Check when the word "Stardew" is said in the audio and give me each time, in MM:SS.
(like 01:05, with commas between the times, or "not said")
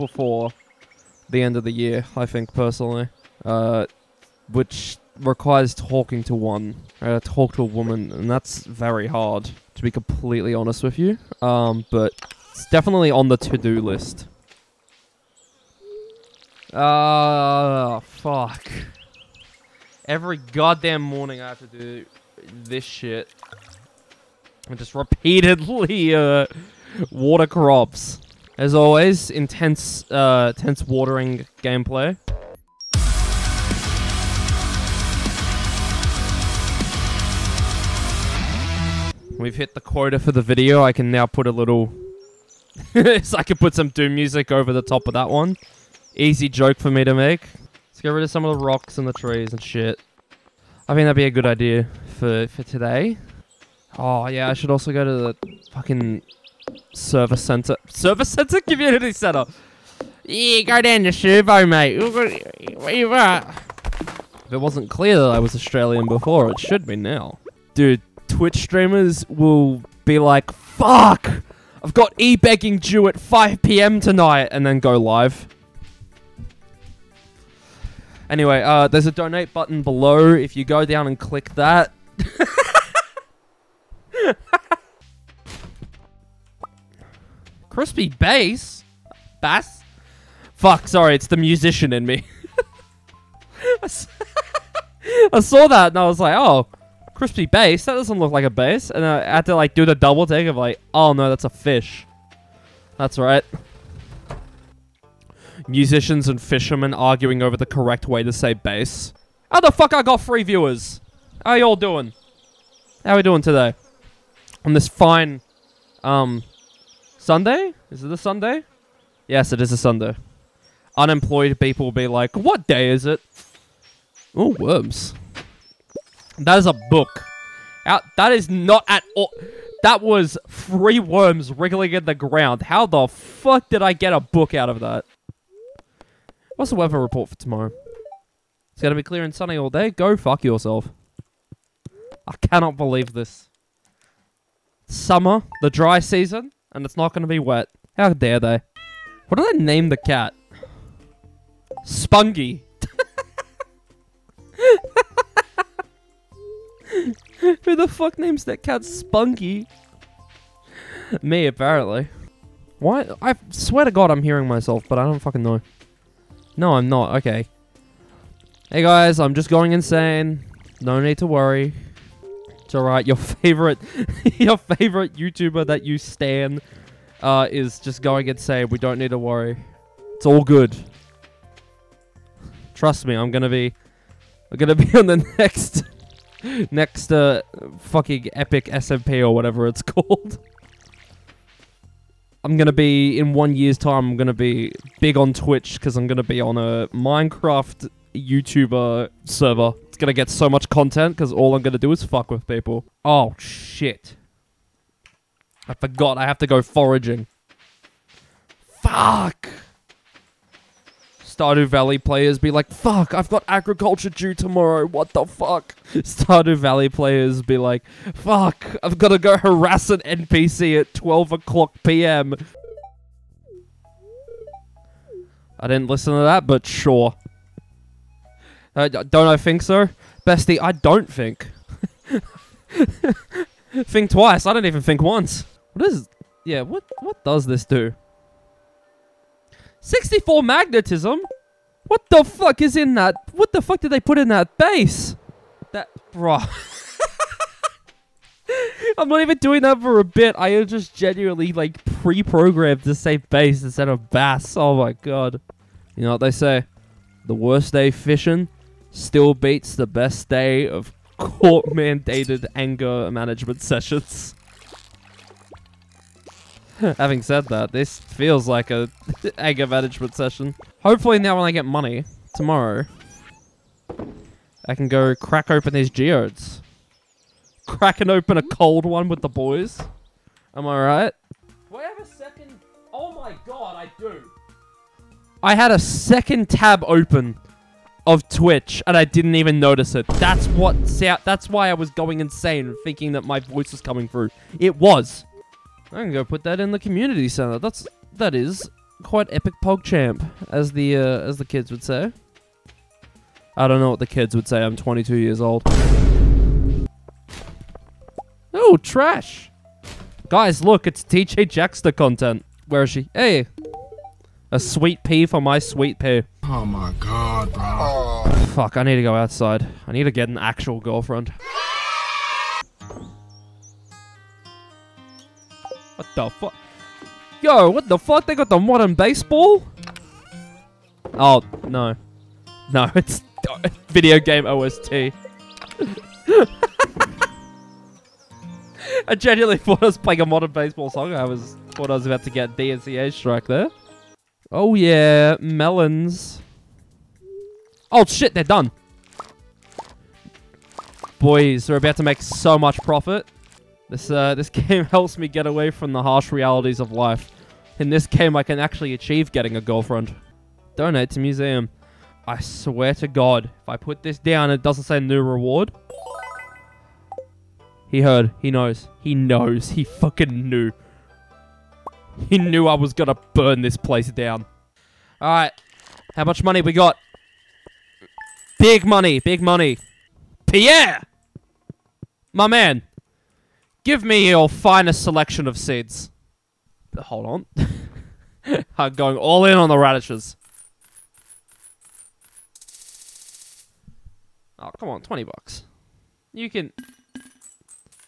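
03:31, 03:35.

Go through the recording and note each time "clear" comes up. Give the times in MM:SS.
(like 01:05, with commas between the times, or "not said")
01:04, 02:19.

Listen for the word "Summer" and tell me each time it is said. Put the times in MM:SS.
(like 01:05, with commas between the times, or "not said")
02:24.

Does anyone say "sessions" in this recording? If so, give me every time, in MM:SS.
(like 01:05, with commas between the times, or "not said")
04:23, 04:30.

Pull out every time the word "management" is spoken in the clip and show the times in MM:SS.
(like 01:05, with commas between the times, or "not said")
04:23, 04:29.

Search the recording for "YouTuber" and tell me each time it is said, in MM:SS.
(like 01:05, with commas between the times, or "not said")
02:55, 03:18.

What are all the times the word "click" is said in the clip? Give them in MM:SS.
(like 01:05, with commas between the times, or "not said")
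01:21.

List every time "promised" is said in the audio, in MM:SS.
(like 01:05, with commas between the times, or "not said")
not said.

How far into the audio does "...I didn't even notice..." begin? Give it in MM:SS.
04:48.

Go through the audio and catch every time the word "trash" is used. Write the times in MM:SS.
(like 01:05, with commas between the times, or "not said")
05:08.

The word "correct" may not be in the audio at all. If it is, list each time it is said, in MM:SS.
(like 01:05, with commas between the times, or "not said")
01:47.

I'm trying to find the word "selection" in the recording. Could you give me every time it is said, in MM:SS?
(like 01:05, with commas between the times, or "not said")
06:25.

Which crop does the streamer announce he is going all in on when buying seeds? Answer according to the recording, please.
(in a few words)
Radishes.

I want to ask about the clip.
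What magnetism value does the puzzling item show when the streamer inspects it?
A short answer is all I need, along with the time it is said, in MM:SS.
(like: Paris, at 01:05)
64, at 03:59.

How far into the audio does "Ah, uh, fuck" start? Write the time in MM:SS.
00:16.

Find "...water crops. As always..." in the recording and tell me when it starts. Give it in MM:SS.
00:27.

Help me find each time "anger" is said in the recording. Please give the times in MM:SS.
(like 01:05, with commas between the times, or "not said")
04:22, 04:29.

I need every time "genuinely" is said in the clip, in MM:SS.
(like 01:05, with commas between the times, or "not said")
04:10, 05:39.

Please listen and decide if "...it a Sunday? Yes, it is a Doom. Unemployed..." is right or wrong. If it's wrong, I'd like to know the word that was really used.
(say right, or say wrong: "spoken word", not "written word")
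wrong: "Sunday", not "Doom".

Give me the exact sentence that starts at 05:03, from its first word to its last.
I don't know what the kids would say.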